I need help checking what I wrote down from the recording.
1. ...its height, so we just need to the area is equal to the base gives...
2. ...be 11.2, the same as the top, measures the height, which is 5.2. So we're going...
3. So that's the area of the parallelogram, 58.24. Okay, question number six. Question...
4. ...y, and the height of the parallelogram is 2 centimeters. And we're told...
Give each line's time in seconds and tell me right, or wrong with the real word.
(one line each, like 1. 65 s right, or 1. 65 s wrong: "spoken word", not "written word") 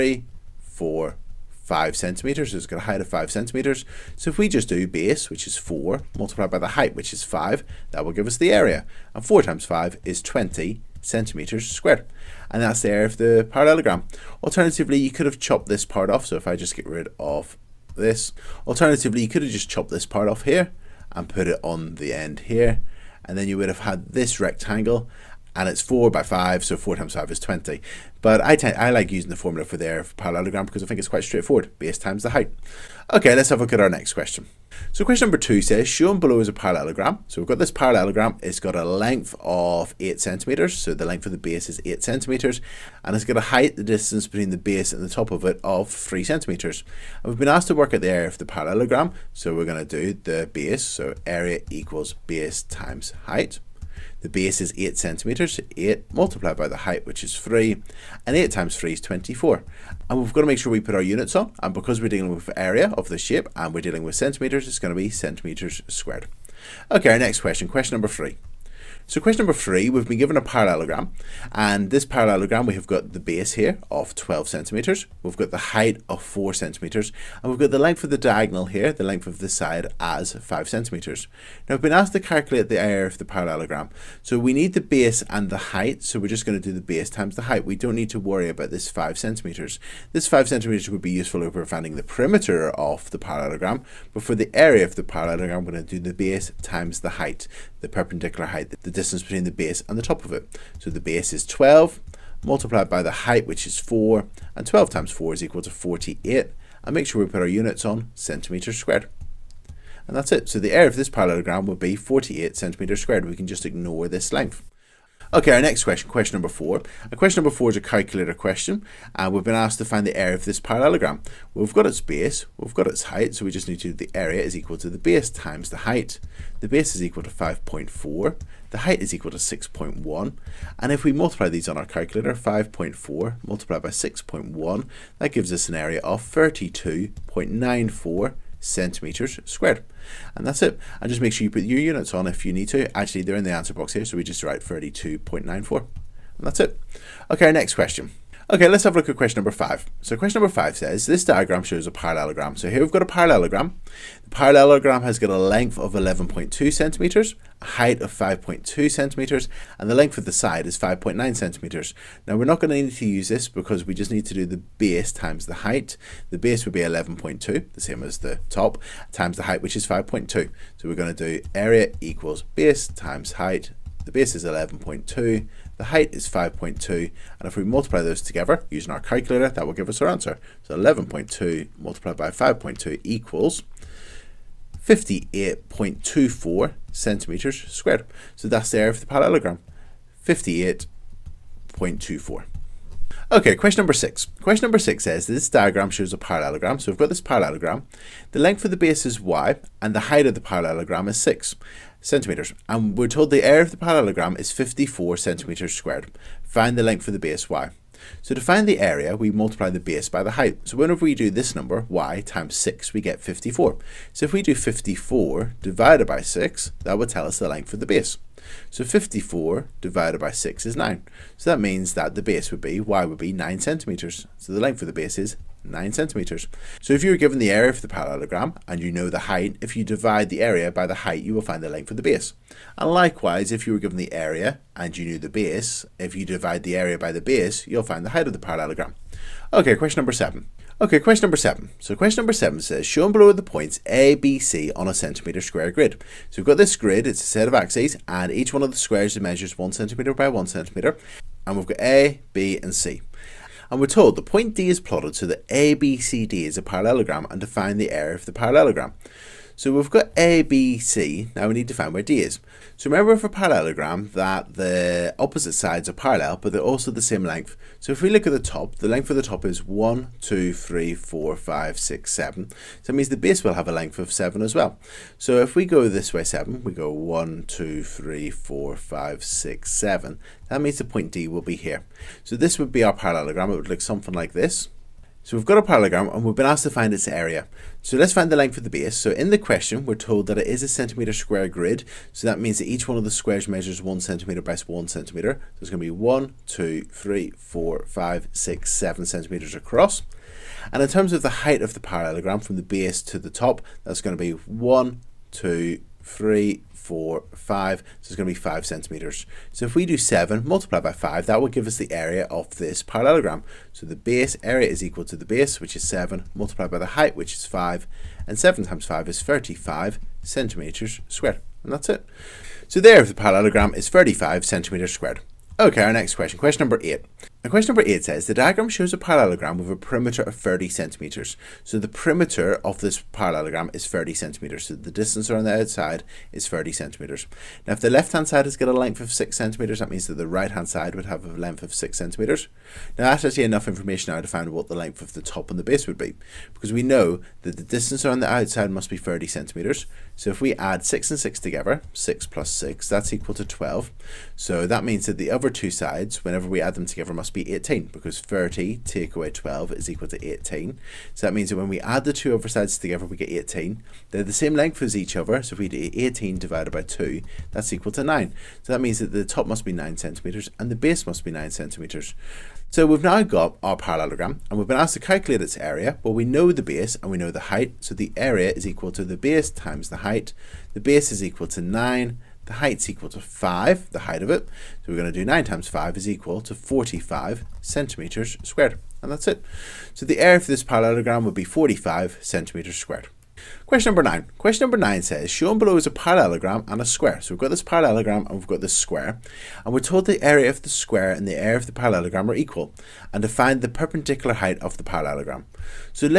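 1. 122 s wrong: "times", not "gives"
2. 166 s wrong: "times", not "measures"
3. 188 s right
4. 199 s wrong: "6", not "2".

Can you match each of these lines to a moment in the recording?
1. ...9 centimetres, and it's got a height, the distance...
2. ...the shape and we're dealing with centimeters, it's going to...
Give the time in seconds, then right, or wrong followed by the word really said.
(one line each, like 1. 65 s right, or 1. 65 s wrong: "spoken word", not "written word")
1. 41 s wrong: "8", not "9"
2. 63 s right.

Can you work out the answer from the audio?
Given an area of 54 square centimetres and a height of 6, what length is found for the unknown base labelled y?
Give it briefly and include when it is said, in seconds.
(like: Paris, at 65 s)
9 centimetres, at 222 s.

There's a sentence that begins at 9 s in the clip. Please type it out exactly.
And four times five is 20 centimeters squared.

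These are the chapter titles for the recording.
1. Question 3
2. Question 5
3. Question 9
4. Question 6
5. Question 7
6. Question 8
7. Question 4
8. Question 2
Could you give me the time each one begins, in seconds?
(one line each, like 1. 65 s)
1. 66 s
2. 146 s
3. 392 s
4. 192 s
5. 238 s
6. 324 s
7. 114 s
8. 32 s.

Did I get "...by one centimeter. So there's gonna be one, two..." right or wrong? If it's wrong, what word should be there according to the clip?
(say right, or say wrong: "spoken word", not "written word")
right.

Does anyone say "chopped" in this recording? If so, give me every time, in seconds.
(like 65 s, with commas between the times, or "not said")
15 s, 19 s.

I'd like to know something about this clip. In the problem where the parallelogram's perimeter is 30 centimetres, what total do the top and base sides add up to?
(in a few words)
18.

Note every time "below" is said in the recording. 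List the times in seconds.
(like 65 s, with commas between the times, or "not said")
36 s, 243 s, 395 s.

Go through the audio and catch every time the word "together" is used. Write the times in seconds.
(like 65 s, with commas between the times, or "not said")
178 s, 351 s, 356 s, 362 s.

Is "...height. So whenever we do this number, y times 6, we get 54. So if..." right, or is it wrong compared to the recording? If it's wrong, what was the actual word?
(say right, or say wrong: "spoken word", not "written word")
right.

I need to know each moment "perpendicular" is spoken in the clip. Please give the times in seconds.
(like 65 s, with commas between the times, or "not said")
97 s, 403 s.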